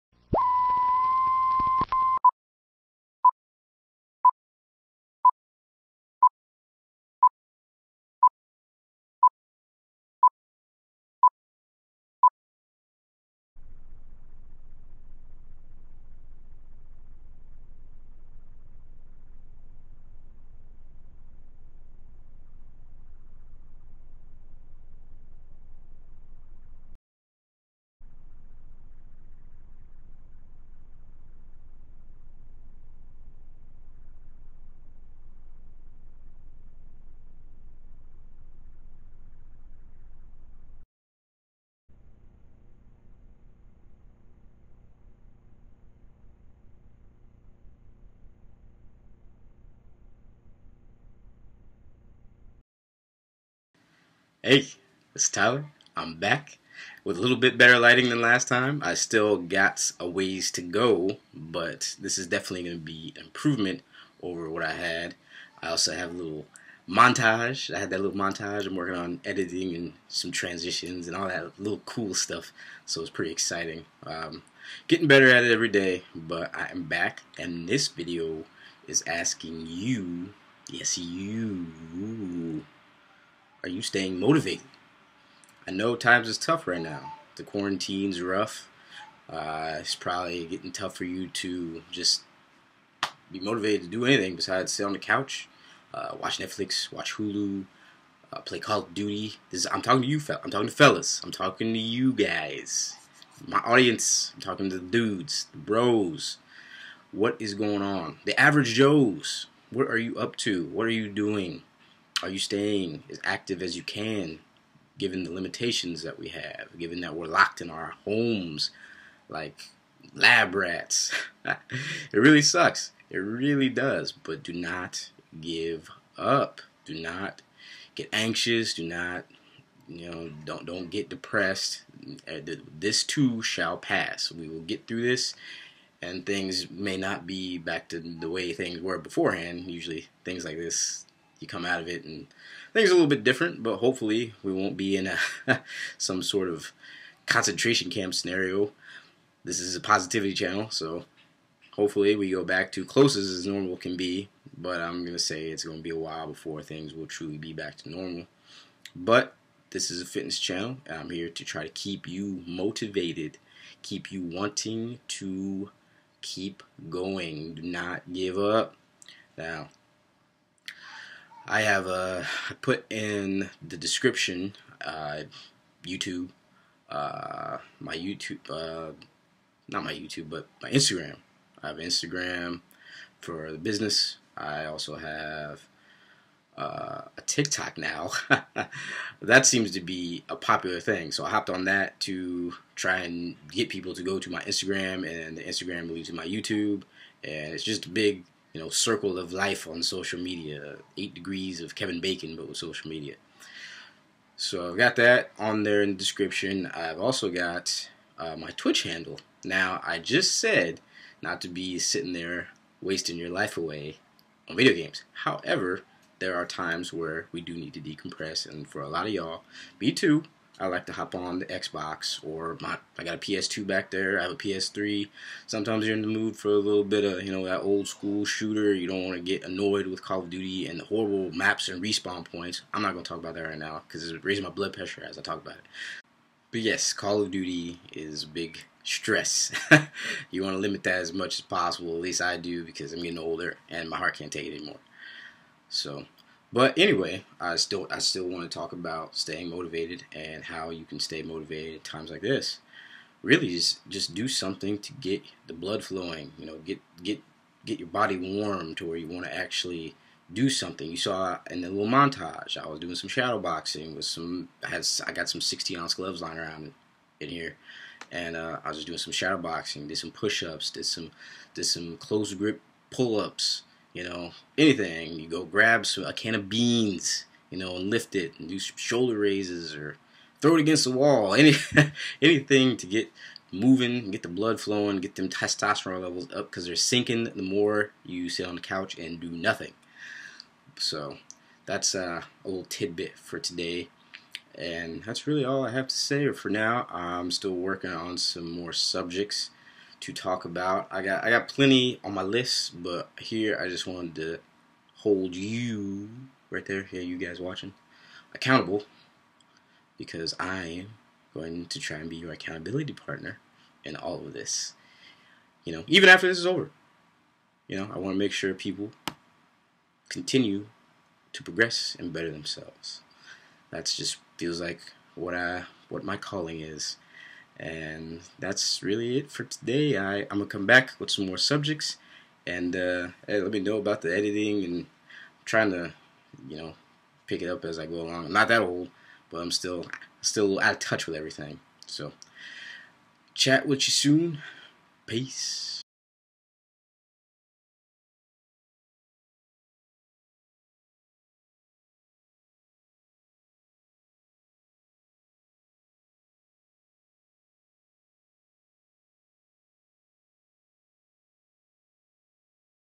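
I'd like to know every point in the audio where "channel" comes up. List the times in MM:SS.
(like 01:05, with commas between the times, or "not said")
02:30, 02:40.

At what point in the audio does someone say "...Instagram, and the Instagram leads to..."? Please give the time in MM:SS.
03:14.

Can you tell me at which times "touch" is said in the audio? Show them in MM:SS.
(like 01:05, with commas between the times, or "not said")
05:40.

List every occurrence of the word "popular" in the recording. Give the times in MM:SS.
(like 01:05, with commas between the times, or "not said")
03:10.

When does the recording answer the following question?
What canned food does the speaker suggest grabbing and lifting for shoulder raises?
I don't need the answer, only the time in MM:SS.
04:36.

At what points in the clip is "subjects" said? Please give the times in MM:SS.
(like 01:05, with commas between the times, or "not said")
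04:58, 05:31.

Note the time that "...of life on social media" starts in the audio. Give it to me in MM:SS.
03:19.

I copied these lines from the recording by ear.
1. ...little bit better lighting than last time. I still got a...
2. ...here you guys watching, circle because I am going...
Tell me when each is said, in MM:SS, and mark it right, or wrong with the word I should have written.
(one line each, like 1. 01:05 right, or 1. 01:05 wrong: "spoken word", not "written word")
1. 00:57 right
2. 05:06 wrong: "accountable", not "circle".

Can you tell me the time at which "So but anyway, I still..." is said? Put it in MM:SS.
04:05.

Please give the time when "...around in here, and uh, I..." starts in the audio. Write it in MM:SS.
04:26.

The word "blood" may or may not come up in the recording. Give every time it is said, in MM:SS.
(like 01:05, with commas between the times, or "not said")
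03:54, 04:15, 04:44.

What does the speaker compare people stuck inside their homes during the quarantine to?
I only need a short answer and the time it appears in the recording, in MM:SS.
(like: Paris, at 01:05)
lab rats, at 02:00.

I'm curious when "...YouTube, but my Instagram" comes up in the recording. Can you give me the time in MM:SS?
02:59.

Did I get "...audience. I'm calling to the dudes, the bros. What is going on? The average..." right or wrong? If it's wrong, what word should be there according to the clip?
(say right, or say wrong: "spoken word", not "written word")
wrong: "talking", not "calling".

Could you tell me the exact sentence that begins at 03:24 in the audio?
So I've got that on there in the description.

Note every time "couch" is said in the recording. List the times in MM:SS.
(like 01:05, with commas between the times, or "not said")
01:34, 04:48.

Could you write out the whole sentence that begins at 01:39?
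This is, I'm talking to you, fell.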